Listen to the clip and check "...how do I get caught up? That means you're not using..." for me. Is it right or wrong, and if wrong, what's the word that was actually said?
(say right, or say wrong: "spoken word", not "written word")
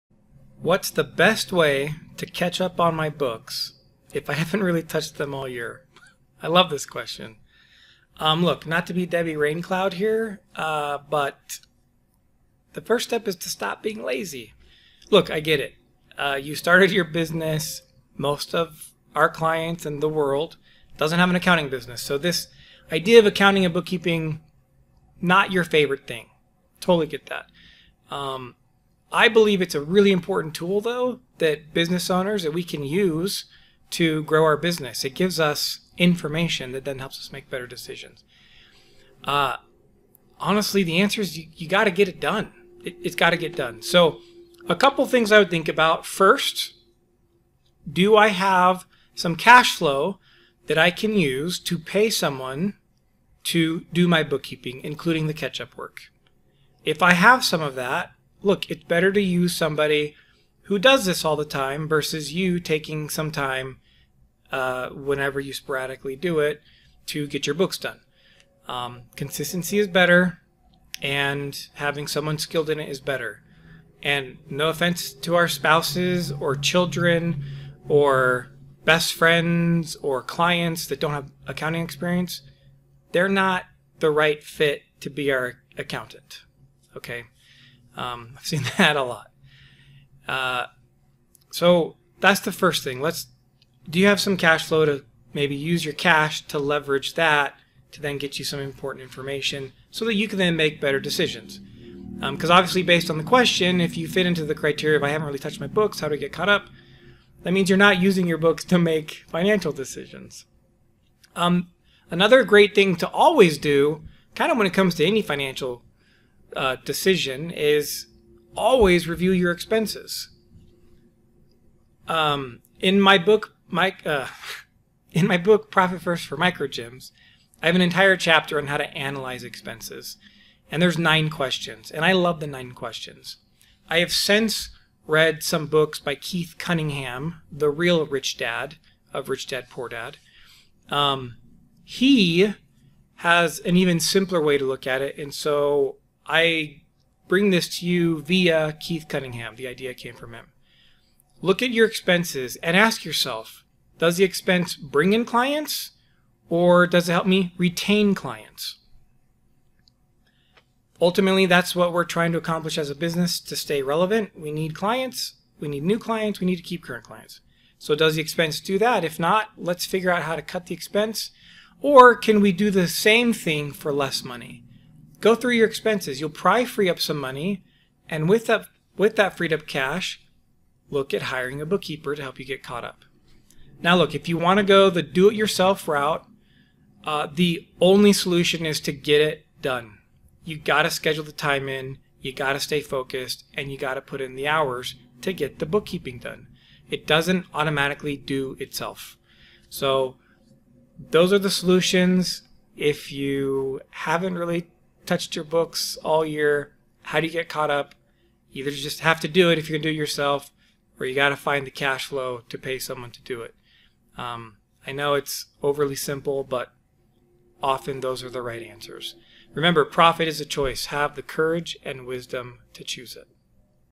right.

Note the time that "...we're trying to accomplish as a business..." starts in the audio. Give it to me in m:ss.
2:41.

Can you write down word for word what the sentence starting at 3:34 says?
Um, I know it's overly simple, but often those are the right answers.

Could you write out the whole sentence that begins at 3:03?
Now, look, if you want to go the do-it-yourself route, uh, the only solution is to get it done.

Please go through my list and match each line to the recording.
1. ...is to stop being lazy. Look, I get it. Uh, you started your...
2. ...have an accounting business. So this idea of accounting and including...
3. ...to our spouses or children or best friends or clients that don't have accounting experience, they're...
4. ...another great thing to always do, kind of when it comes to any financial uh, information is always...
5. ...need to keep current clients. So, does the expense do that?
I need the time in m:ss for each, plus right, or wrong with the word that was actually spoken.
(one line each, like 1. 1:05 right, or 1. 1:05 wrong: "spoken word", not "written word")
1. 0:13 right
2. 0:21 wrong: "bookkeeping", not "including"
3. 1:15 right
4. 1:52 wrong: "decision", not "information"
5. 2:46 right.